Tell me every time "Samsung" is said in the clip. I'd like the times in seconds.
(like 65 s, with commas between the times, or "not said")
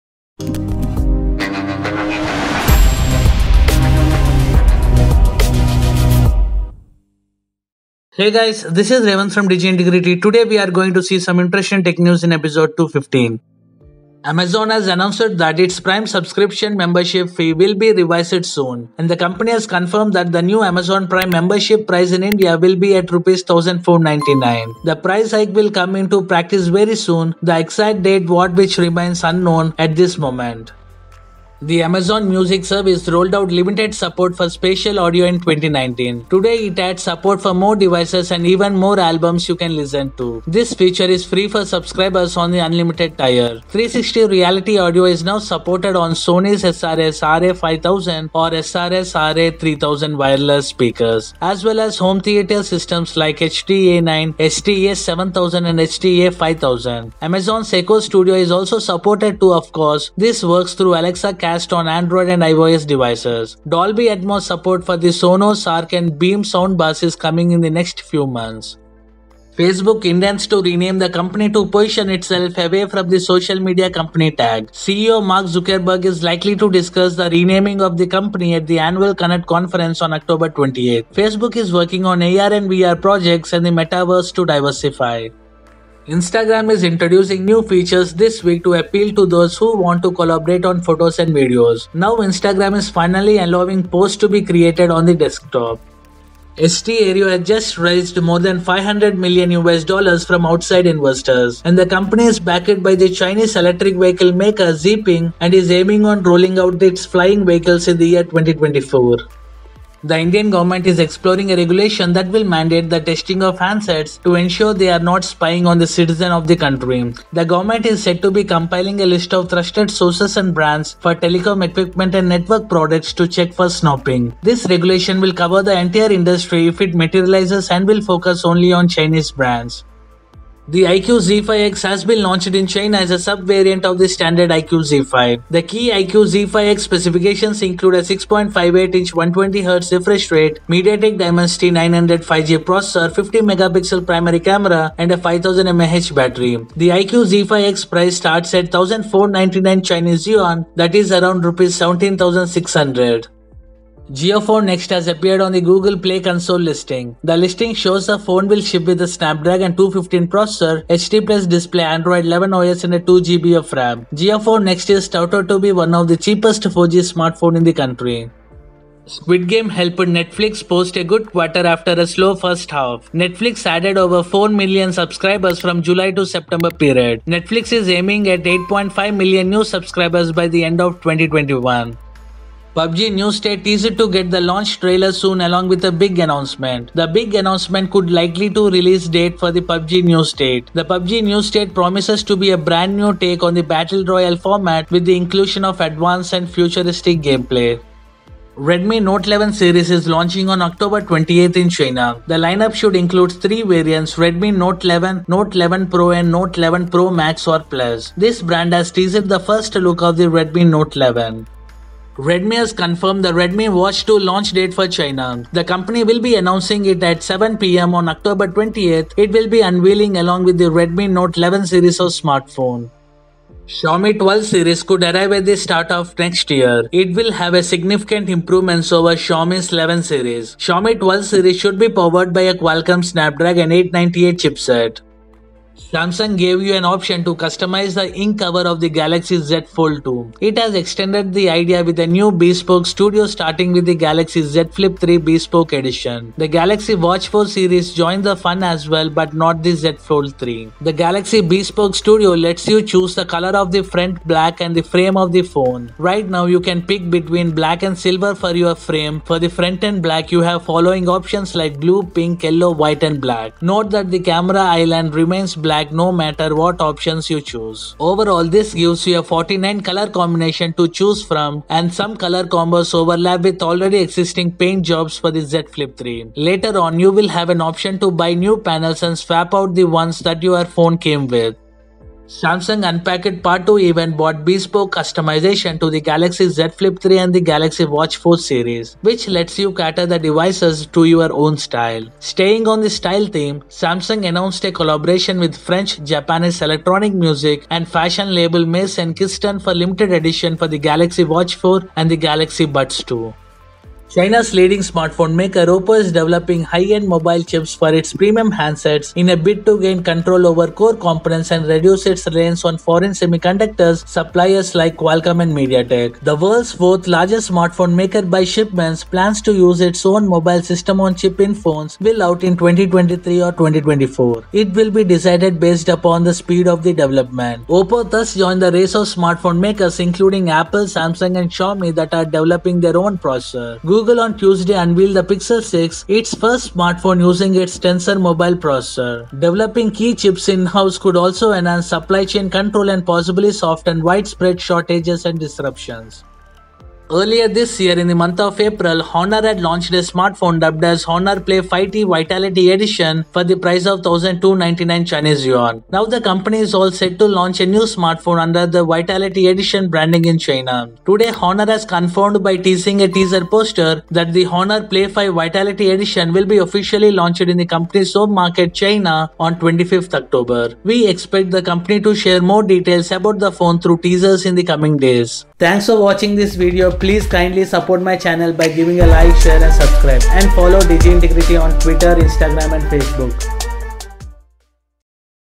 235 s, 282 s, 293 s, 330 s.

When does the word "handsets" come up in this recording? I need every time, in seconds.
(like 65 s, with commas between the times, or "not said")
113 s, 308 s.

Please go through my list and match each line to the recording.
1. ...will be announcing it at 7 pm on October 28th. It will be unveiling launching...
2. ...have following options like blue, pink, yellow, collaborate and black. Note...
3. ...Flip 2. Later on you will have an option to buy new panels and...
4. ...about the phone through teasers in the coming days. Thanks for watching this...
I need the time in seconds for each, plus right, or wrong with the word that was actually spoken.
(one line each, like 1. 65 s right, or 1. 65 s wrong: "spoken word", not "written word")
1. 216 s wrong: "along", not "launching"
2. 260 s wrong: "white", not "collaborate"
3. 275 s wrong: "3", not "2"
4. 373 s right.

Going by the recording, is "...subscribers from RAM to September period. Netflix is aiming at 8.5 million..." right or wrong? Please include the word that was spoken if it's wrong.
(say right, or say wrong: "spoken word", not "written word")
wrong: "July", not "RAM".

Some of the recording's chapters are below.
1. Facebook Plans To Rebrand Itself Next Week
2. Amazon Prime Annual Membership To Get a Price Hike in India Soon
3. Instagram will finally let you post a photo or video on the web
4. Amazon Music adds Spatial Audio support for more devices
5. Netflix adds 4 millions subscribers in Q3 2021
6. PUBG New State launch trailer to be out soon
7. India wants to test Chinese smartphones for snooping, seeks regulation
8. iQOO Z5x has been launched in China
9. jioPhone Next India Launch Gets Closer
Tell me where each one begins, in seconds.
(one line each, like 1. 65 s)
1. 69 s
2. 14 s
3. 86 s
4. 31 s
5. 169 s
6. 182 s
7. 110 s
8. 130 s
9. 154 s.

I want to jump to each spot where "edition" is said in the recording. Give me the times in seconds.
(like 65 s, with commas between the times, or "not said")
245 s, 300 s, 352 s, 359 s, 365 s.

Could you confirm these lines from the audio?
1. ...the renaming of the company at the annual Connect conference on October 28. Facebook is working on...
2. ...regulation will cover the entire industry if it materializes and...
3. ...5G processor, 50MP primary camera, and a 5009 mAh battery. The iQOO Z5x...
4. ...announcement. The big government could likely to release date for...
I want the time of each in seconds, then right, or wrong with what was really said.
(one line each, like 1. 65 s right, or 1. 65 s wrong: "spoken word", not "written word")
1. 77 s right
2. 124 s right
3. 142 s wrong: "5000", not "5009"
4. 186 s wrong: "announcement", not "government".